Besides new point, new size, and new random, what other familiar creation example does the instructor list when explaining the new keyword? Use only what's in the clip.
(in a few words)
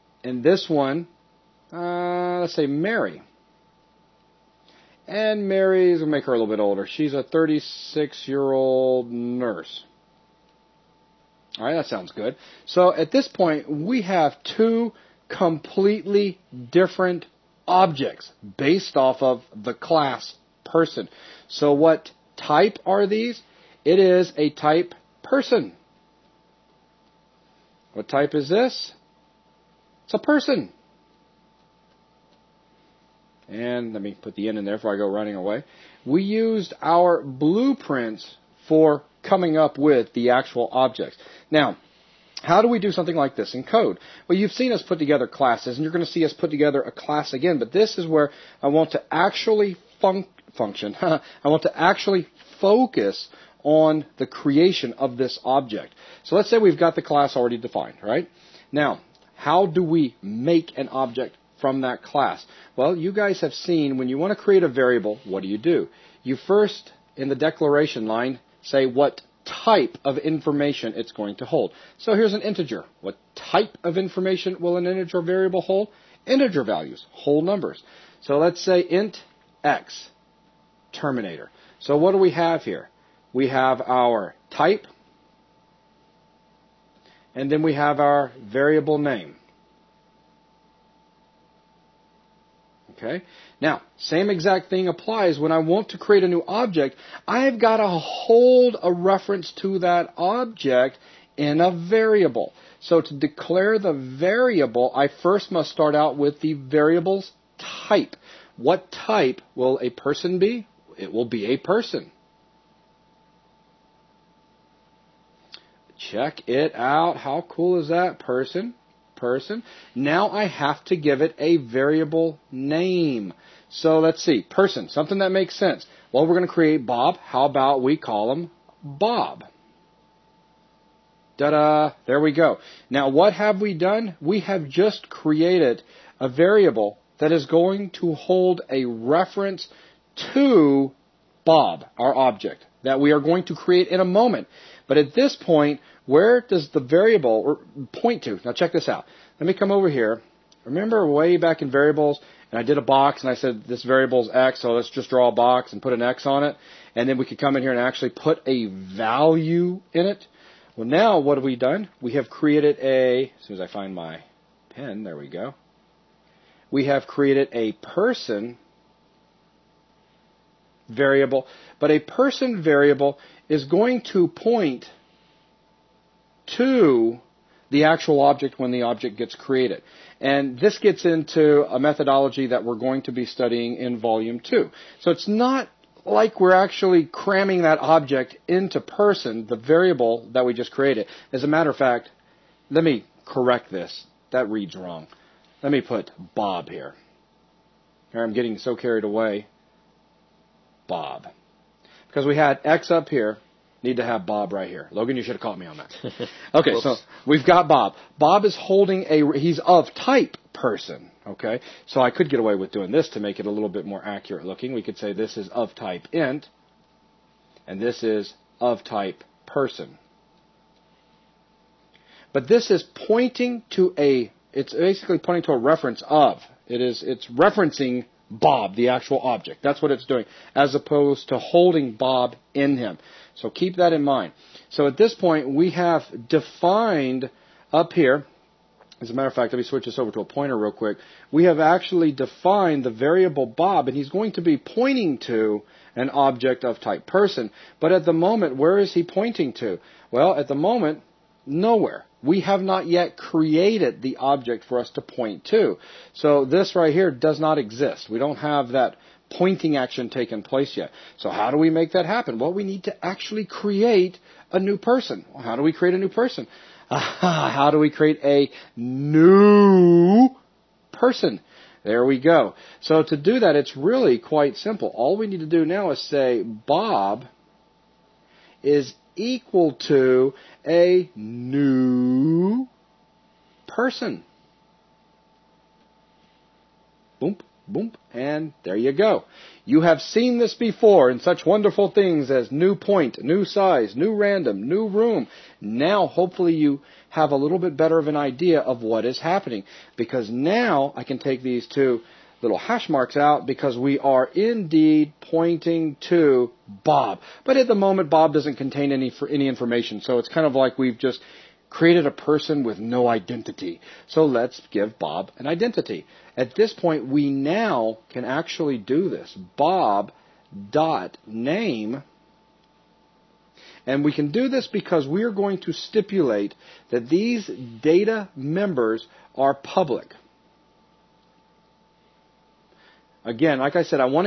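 new room.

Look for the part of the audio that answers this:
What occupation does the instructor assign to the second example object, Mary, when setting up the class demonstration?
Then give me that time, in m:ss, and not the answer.
0:09.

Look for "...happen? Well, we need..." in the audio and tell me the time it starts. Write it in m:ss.
4:22.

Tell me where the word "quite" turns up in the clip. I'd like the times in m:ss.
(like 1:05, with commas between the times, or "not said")
4:34.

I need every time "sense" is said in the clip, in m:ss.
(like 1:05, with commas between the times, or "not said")
2:05.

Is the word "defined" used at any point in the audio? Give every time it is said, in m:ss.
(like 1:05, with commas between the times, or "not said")
0:57, 3:56, 4:02.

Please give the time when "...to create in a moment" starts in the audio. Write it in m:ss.
2:23.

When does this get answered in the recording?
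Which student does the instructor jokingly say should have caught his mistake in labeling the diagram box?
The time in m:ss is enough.
3:24.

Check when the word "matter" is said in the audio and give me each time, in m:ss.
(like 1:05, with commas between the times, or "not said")
3:11, 3:59.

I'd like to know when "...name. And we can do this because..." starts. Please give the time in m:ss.
5:21.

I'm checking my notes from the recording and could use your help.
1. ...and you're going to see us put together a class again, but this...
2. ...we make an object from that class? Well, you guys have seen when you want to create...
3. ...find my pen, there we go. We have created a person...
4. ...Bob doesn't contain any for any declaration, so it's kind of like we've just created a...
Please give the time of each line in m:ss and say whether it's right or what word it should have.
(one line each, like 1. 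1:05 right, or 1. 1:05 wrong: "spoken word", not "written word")
1. 0:45 right
2. 0:59 right
3. 2:43 right
4. 5:08 wrong: "information", not "declaration".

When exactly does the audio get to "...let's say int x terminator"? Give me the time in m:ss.
1:18.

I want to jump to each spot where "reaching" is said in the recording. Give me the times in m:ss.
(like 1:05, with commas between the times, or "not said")
not said.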